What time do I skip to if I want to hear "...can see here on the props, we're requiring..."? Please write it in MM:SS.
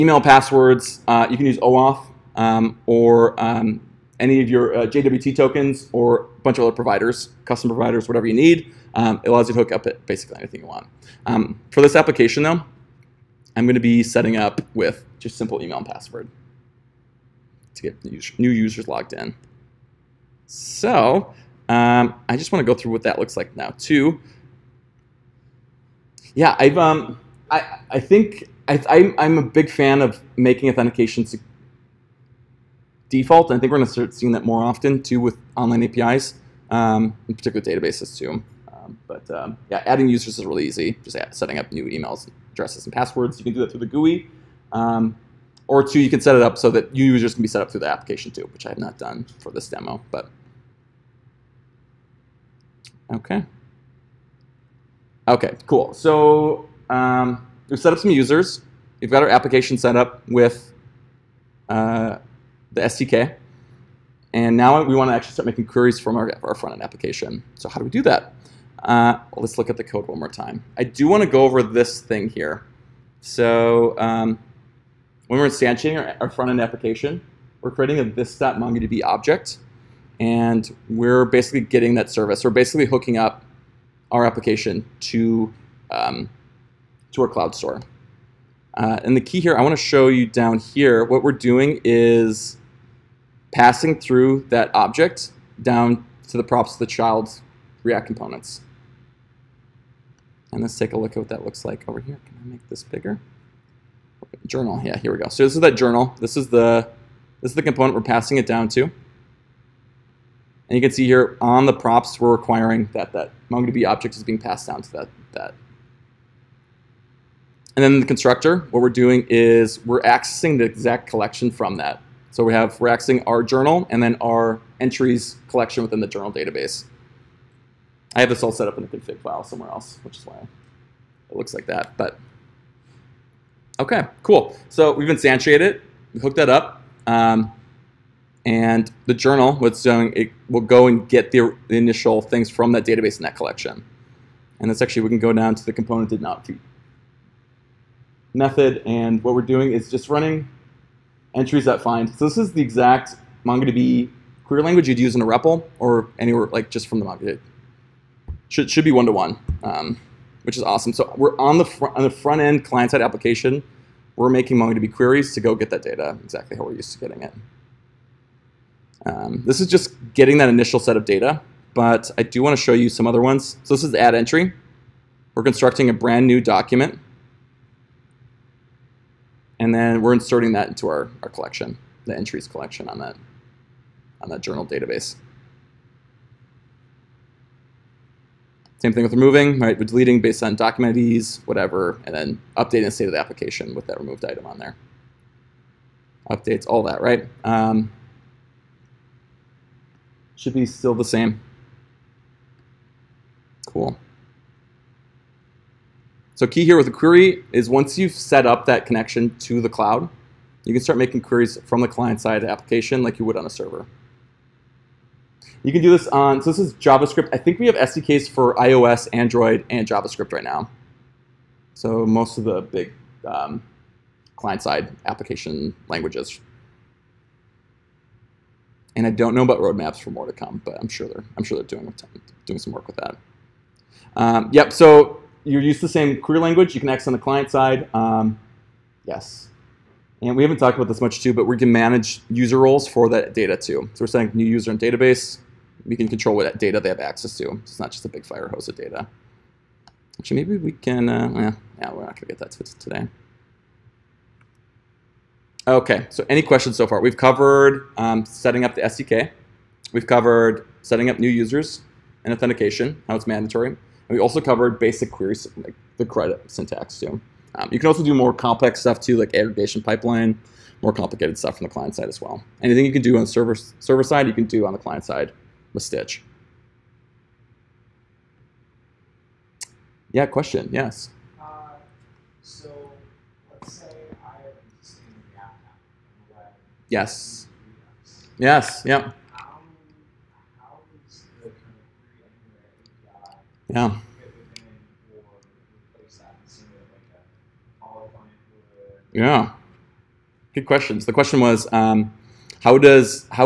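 01:50.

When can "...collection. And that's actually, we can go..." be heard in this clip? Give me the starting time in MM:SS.
02:23.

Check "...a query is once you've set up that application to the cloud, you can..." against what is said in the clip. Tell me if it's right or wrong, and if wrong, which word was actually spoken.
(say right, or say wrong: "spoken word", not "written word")
wrong: "connection", not "application".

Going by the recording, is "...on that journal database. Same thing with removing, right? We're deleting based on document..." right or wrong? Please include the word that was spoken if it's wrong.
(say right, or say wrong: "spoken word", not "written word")
right.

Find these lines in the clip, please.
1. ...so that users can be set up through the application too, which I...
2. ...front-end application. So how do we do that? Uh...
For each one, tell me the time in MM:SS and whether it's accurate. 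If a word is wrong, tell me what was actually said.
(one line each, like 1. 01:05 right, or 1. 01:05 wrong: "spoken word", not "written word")
1. 00:46 right
2. 01:06 right.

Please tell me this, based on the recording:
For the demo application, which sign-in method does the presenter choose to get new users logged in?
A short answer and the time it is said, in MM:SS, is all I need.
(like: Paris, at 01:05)
email and password, at 00:15.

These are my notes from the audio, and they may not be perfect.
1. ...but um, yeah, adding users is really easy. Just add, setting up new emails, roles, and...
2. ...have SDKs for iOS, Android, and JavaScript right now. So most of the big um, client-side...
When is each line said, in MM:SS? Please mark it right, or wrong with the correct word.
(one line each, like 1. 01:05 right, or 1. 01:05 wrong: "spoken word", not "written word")
1. 00:39 wrong: "addresses", not "roles"
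2. 03:37 right.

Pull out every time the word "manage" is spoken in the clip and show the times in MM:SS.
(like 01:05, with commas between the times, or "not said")
04:01.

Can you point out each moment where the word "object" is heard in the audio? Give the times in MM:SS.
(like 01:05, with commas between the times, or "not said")
01:19, 01:34, 01:53.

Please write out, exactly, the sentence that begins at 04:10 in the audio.
Actually, maybe we can, uh, yeah, yeah, we're not gonna get that today.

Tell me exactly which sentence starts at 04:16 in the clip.
We've covered um, setting up the SDK.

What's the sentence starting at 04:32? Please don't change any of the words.
Anything you can do on server, server side, you can do on the client side with Stitch.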